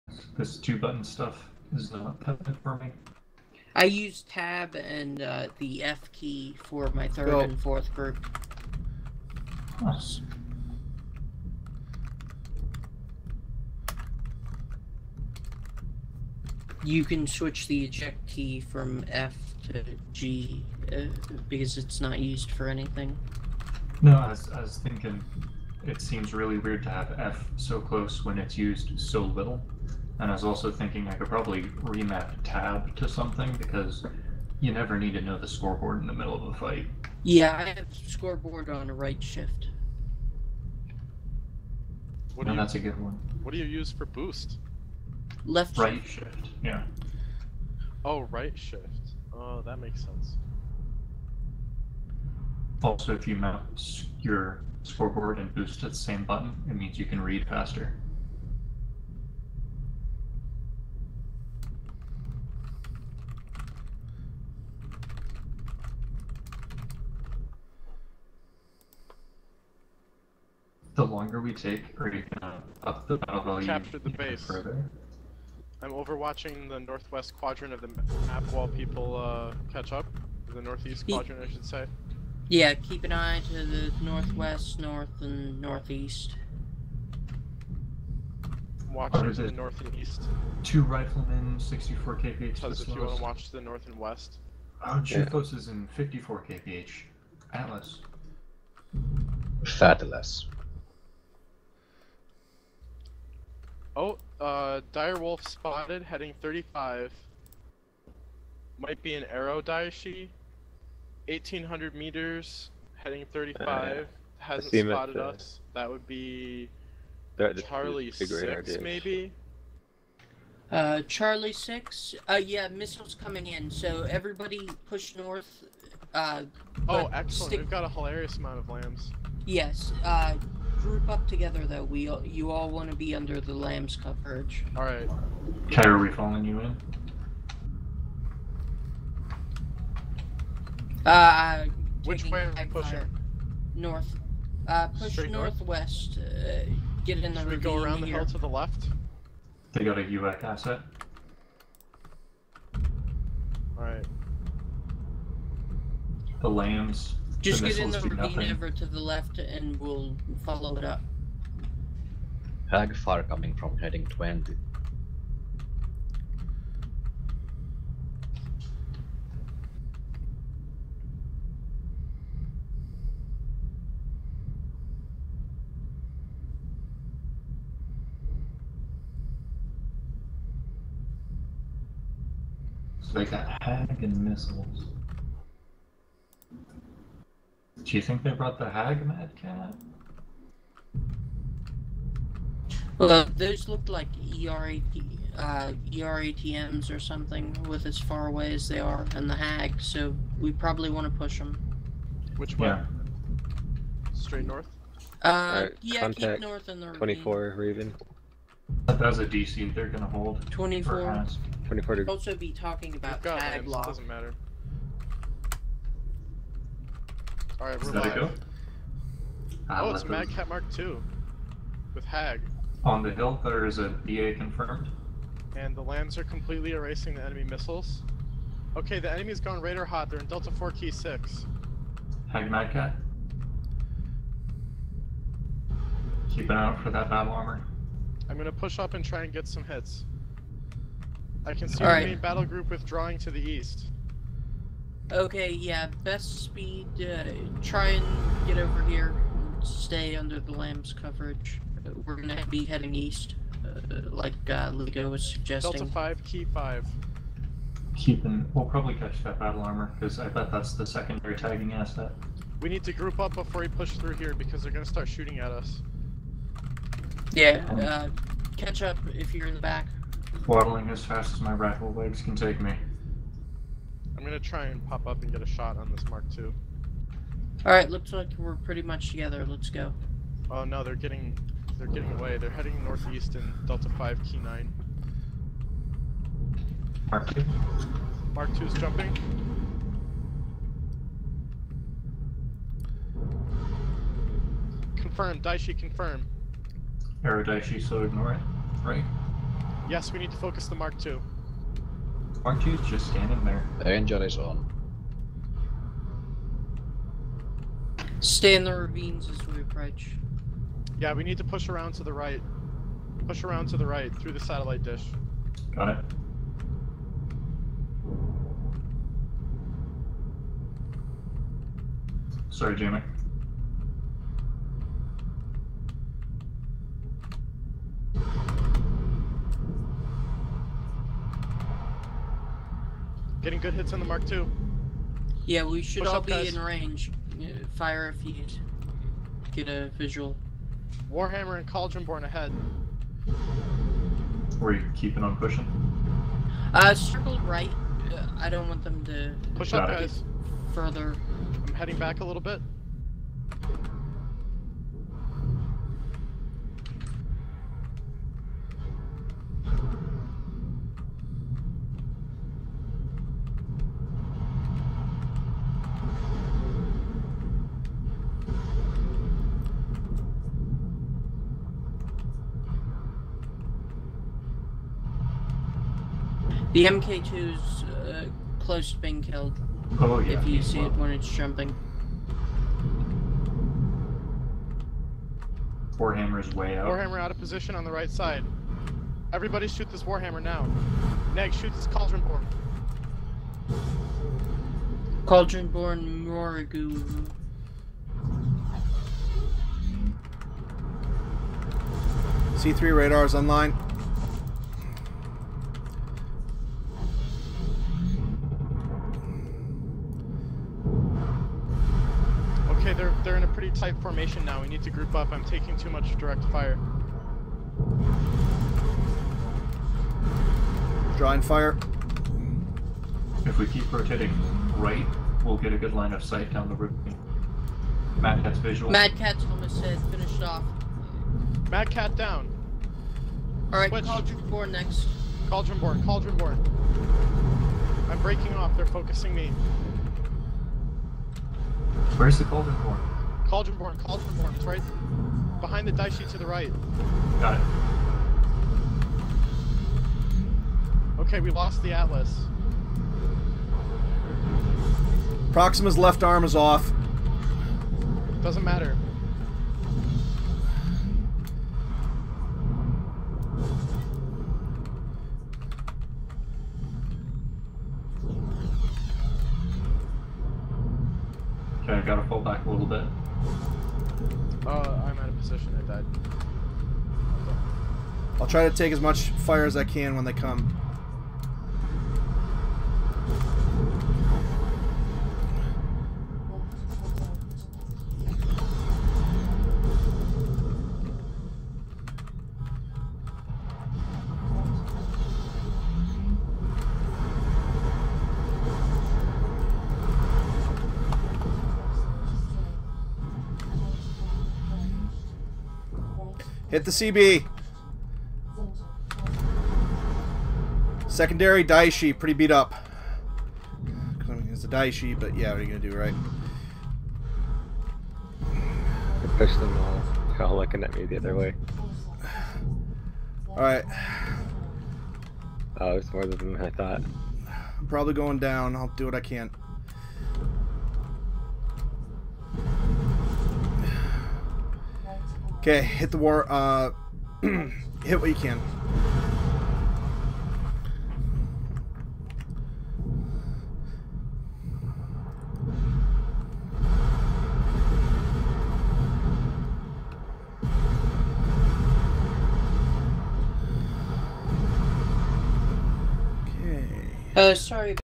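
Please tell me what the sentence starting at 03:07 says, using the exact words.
Do you think they brought the hag mad cat?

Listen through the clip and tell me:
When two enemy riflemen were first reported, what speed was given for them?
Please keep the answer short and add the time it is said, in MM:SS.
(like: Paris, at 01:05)
64 kph, at 01:31.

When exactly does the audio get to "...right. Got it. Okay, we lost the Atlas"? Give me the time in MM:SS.
07:26.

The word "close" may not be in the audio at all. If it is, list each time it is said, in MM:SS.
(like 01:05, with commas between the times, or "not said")
00:27, 06:18.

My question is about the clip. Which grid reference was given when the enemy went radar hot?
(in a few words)
Delta 4 Key 6.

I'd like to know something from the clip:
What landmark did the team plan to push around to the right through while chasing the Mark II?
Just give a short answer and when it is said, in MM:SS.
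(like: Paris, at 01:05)
Satellite dish, at 05:14.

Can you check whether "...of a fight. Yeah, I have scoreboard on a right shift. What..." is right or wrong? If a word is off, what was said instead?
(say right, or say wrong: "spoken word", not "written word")
right.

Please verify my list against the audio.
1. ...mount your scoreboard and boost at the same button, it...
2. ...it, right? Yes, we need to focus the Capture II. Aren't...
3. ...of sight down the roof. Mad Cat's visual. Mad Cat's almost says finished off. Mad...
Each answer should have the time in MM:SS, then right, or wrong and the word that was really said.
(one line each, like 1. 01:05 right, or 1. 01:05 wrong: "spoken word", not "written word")
1. 00:53 right
2. 04:58 wrong: "Mark", not "Capture"
3. 07:06 right.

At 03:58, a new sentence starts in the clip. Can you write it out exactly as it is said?
I'm gonna push up and try and get some hits.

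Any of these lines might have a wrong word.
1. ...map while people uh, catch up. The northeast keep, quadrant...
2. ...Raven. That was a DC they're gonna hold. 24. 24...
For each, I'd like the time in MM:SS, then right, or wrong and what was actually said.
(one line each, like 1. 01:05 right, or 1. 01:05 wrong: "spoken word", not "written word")
1. 01:18 right
2. 03:27 right.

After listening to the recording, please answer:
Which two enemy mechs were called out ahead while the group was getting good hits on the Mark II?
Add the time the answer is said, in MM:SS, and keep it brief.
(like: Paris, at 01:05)
Warhammer and Cauldronborn, at 05:41.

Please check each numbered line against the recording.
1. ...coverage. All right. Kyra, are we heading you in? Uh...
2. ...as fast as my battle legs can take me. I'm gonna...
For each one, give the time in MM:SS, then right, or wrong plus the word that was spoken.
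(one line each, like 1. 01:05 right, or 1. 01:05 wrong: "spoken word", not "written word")
1. 02:13 wrong: "following", not "heading"
2. 04:30 wrong: "rifle", not "battle".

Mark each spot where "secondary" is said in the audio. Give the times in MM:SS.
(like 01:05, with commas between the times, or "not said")
04:20, 08:31.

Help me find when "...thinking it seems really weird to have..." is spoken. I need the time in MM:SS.
00:24.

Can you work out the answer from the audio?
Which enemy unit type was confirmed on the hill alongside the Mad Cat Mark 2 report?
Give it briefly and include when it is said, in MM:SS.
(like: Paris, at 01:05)
Battle armor, at 03:43.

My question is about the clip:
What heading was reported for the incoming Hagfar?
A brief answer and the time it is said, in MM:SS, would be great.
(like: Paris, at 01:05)
20, at 02:44.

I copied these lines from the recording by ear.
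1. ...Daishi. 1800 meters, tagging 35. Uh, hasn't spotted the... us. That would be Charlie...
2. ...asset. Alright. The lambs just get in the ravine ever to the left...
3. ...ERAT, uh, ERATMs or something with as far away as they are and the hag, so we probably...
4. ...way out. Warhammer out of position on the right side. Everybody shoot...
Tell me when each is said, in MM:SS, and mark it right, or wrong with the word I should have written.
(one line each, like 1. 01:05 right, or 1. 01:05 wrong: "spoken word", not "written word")
1. 01:49 wrong: "heading", not "tagging"
2. 02:30 right
3. 03:14 right
4. 06:26 right.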